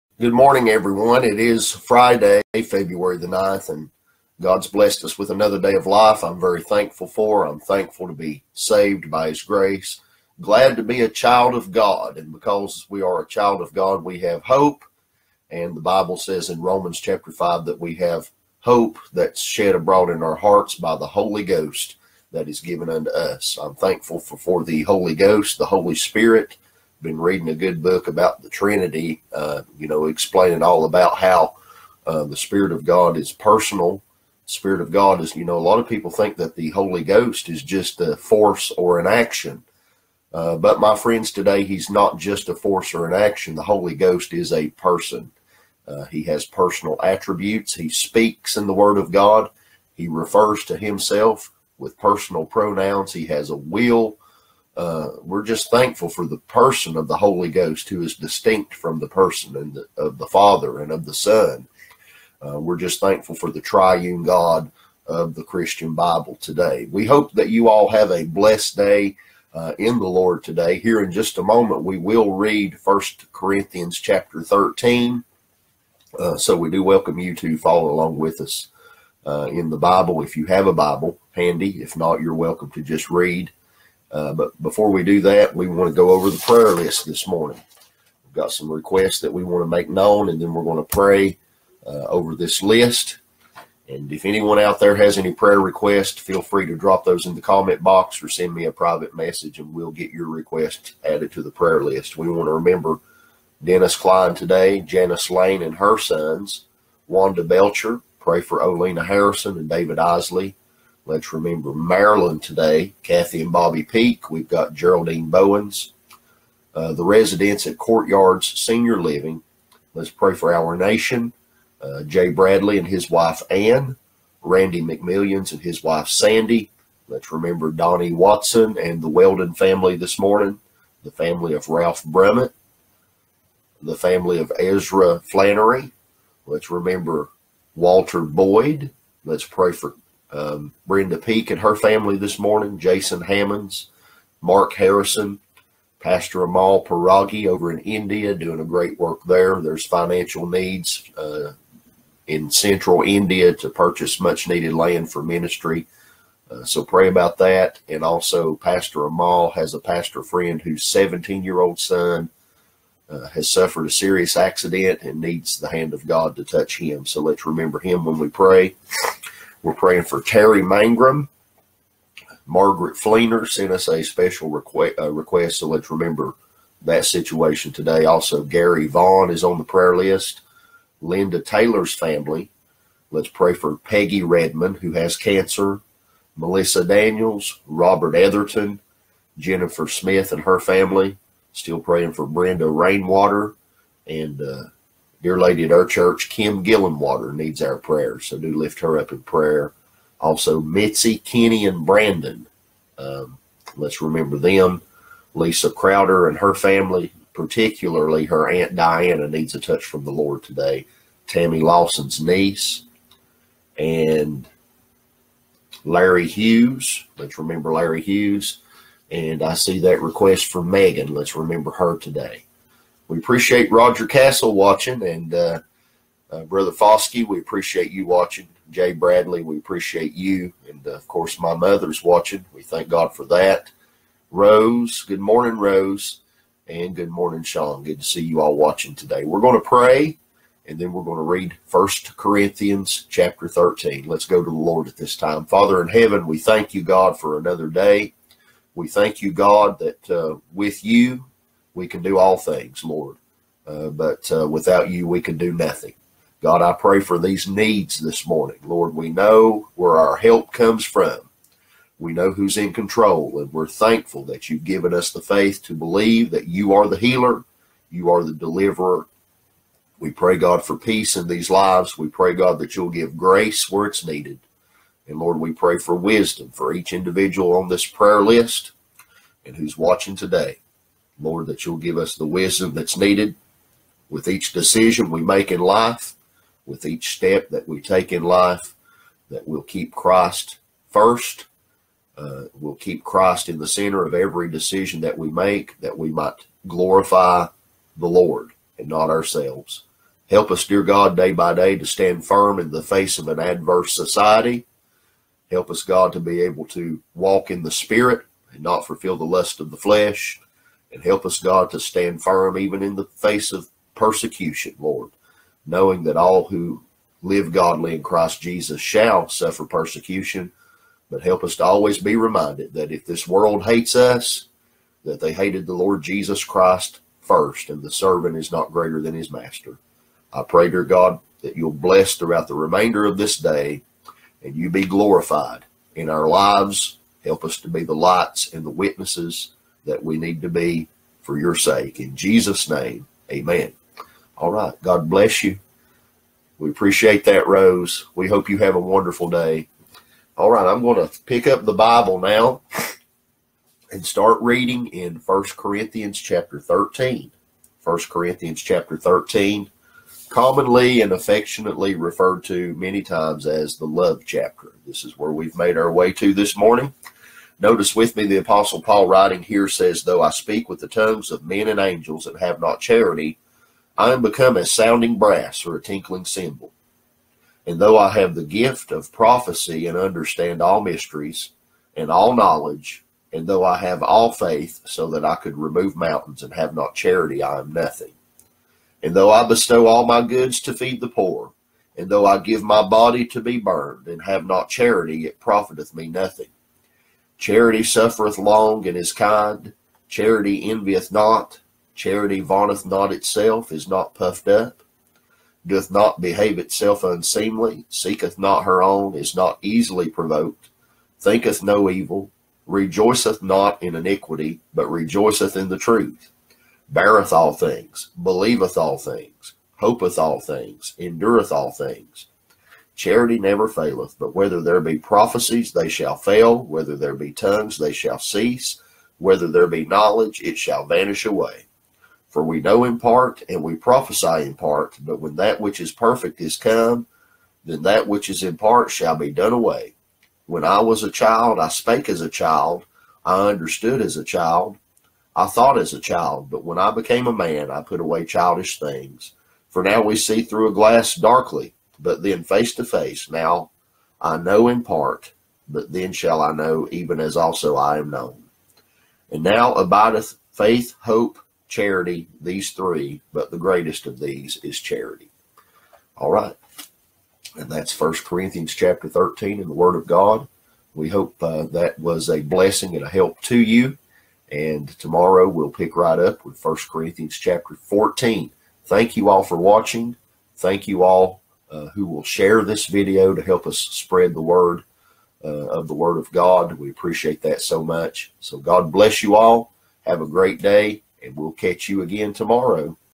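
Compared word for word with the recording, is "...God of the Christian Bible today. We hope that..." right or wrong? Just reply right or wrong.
right.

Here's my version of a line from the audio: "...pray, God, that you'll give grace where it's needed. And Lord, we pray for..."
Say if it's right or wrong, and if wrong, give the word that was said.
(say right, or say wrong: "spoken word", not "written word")
right.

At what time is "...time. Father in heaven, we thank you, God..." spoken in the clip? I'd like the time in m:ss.
4:05.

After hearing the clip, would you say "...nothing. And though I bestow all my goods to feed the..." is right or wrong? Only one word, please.
right.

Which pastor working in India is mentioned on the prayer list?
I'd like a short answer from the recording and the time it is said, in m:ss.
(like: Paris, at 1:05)
Amal Paragi, at 2:25.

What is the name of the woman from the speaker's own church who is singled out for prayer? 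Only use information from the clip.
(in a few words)
Kim Gillenwater.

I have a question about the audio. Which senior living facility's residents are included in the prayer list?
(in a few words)
Courtyards Senior Living.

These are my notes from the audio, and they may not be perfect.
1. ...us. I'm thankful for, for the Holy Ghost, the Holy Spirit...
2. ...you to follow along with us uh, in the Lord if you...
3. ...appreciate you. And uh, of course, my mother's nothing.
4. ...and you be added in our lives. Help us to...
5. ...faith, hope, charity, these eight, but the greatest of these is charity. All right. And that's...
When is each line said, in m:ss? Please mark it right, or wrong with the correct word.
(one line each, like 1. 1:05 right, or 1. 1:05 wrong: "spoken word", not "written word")
1. 0:23 right
2. 1:17 wrong: "Bible", not "Lord"
3. 3:49 wrong: "watching", not "nothing"
4. 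5:34 wrong: "glorified", not "added"
5. 7:40 wrong: "three", not "eight".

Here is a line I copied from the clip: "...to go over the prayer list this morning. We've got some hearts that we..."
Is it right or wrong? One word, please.
wrong.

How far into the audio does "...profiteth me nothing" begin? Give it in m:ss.
6:35.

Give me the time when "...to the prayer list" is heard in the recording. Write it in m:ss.
1:41.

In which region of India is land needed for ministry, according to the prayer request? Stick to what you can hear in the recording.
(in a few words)
Central India.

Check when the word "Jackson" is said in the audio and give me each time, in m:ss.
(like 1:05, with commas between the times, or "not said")
not said.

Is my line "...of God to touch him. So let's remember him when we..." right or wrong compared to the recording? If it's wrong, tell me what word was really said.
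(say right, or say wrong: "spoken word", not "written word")
right.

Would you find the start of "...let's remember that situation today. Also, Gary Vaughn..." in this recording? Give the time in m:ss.
2:55.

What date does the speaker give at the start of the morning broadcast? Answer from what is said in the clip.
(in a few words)
February 9.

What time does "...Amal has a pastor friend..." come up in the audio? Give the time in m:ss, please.
2:39.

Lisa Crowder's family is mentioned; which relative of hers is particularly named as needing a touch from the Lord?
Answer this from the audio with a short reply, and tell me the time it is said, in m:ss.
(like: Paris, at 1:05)
Aunt Diana, at 3:28.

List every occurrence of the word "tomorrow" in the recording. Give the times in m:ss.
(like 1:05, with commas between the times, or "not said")
7:54, 8:12.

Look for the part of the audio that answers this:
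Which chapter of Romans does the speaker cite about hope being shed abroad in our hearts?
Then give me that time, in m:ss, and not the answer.
0:16.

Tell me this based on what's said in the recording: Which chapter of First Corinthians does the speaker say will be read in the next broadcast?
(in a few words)
Chapter 14.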